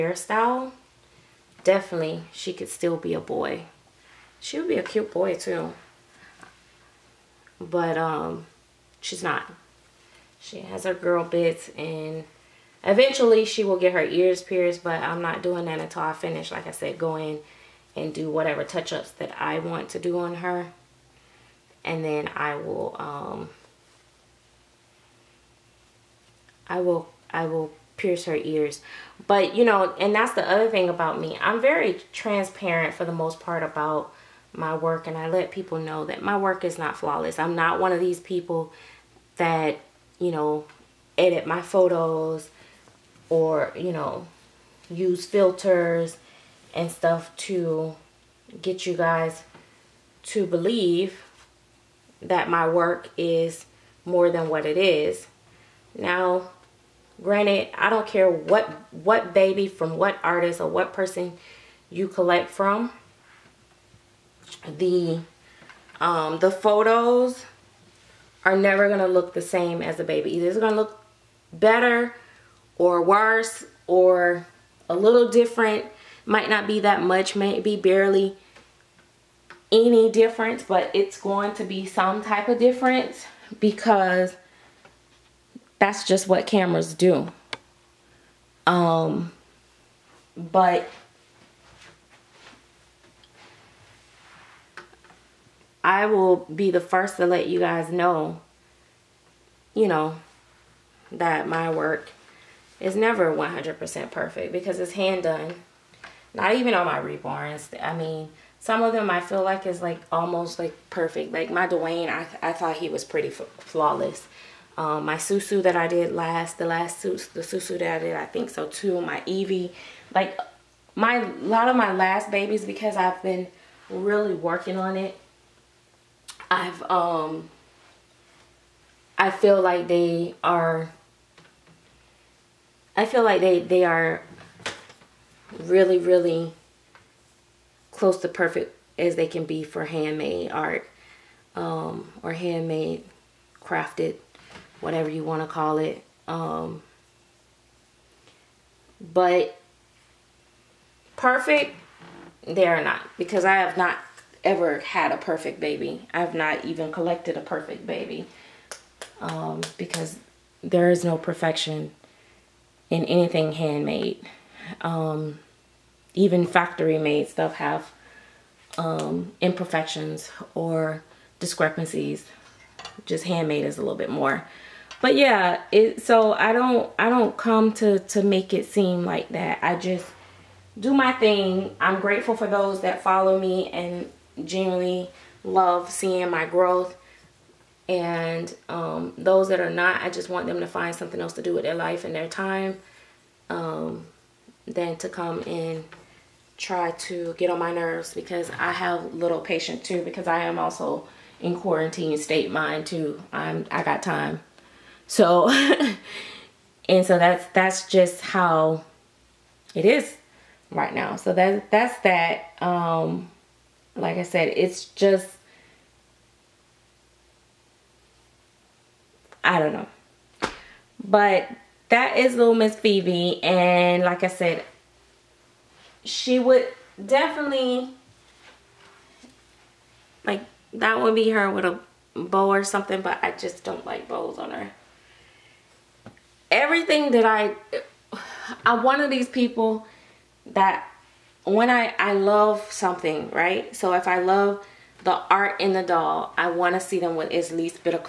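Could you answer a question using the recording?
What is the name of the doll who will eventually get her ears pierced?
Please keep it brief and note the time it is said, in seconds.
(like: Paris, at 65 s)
Phoebe, at 222 s.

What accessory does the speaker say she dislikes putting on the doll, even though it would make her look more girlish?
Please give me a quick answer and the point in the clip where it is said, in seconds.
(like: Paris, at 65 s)
A bow, at 234 s.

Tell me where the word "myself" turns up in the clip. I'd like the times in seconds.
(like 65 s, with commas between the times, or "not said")
not said.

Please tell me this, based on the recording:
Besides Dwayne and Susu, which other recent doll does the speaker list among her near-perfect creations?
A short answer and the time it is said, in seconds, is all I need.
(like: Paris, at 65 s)
Evie, at 119 s.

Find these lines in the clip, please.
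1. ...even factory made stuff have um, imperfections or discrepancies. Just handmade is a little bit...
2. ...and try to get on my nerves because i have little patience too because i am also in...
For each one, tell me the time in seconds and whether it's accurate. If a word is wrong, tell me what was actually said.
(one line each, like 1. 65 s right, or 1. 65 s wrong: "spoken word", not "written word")
1. 166 s right
2. 195 s right.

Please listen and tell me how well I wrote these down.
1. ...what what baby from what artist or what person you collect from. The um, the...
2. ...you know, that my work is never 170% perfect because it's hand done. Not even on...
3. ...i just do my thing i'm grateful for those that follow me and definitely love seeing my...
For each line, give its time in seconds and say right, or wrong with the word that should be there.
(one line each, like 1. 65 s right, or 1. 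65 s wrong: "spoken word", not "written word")
1. 58 s right
2. 99 s wrong: "100", not "170"
3. 179 s wrong: "genuinely", not "definitely".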